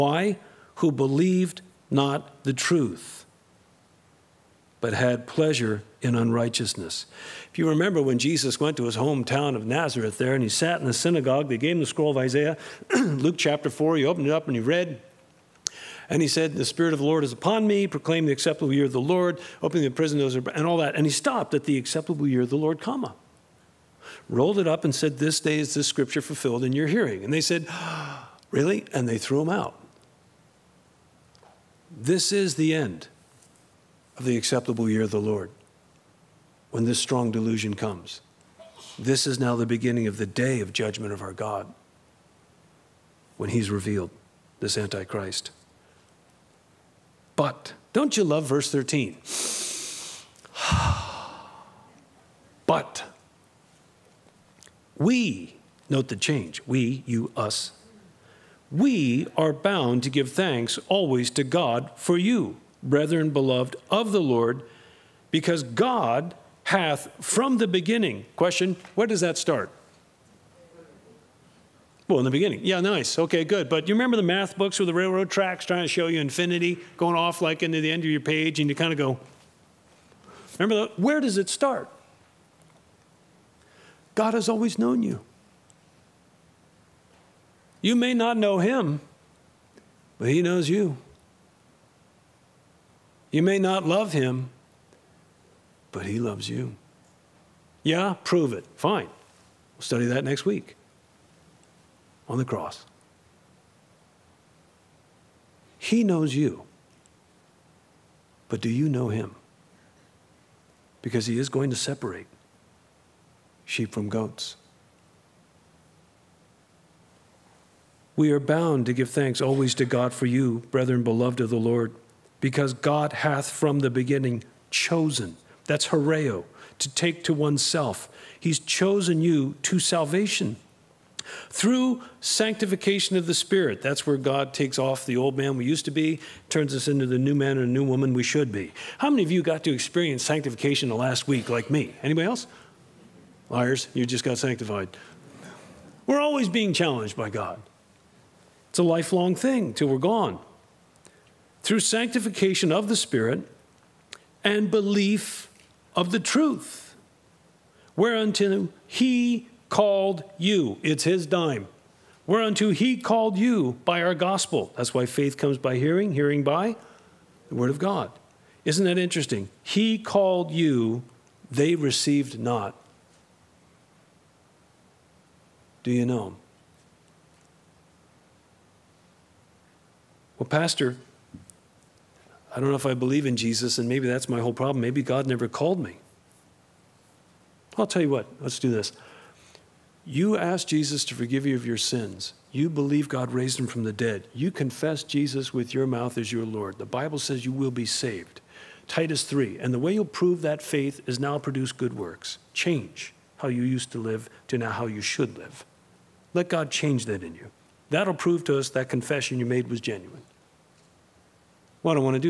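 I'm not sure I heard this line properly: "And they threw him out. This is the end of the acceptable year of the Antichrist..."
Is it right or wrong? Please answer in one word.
wrong.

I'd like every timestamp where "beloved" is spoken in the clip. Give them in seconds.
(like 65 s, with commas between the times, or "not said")
63 s, 121 s.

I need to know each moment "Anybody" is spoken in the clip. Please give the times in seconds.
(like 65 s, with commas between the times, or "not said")
142 s.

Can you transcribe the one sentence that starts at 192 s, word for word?
You believe God raised him from the dead.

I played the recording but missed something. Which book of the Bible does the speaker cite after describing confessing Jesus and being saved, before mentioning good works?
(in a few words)
Titus 3.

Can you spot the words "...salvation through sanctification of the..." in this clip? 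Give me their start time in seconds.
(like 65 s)
129 s.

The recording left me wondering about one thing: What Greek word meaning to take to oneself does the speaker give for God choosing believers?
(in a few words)
horeo.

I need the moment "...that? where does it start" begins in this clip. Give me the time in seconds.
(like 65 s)
80 s.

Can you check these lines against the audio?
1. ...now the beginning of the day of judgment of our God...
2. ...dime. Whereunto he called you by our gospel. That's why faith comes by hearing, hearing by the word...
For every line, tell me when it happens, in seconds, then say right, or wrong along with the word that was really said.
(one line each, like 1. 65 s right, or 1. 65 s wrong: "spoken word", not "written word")
1. 39 s right
2. 161 s right.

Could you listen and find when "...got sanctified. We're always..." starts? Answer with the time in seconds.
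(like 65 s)
144 s.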